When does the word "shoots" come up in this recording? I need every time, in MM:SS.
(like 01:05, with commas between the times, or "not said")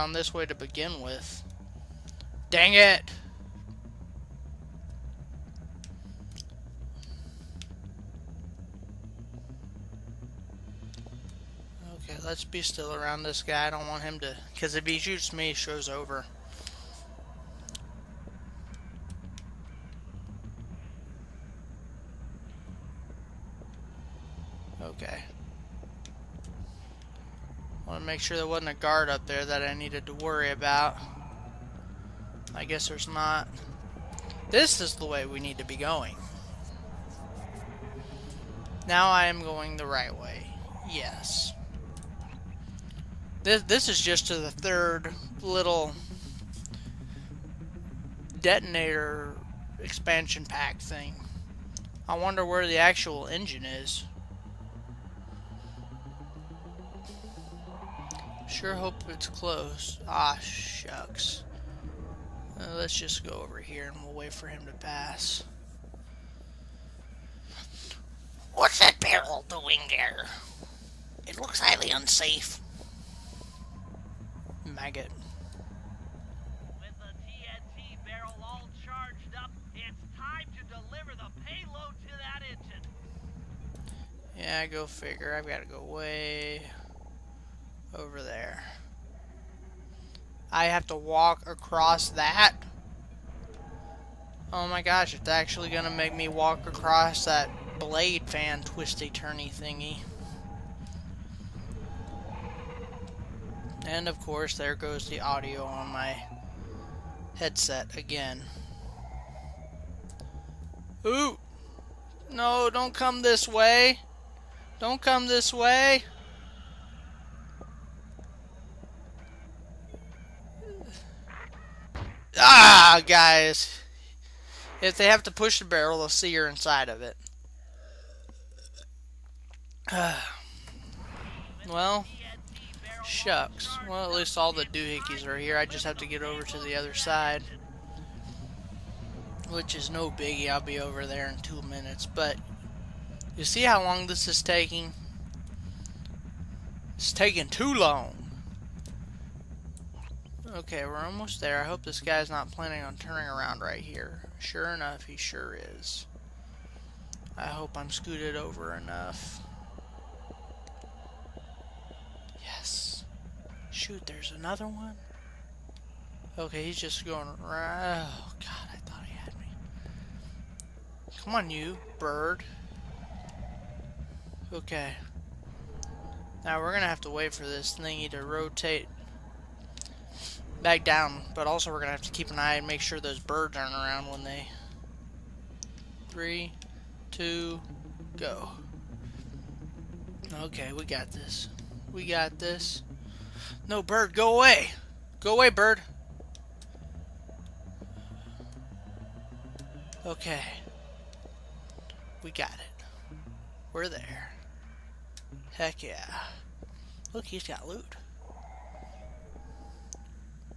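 00:14, 02:43.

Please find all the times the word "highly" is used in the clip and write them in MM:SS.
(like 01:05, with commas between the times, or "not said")
01:11.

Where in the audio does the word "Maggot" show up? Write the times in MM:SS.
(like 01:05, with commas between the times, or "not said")
01:14.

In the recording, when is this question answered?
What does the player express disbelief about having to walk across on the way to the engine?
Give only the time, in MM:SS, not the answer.
01:37.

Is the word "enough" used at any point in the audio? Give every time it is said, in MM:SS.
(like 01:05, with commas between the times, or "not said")
02:34, 02:38.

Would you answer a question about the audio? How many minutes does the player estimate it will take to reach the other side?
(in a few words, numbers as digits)
2.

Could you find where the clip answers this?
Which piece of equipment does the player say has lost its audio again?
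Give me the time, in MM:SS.
01:47.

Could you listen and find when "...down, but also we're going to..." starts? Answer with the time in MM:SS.
03:00.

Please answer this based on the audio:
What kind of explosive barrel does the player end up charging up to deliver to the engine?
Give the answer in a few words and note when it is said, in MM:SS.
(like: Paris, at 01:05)
TNT, at 01:17.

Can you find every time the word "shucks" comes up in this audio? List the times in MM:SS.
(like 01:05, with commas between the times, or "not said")
01:00, 02:13.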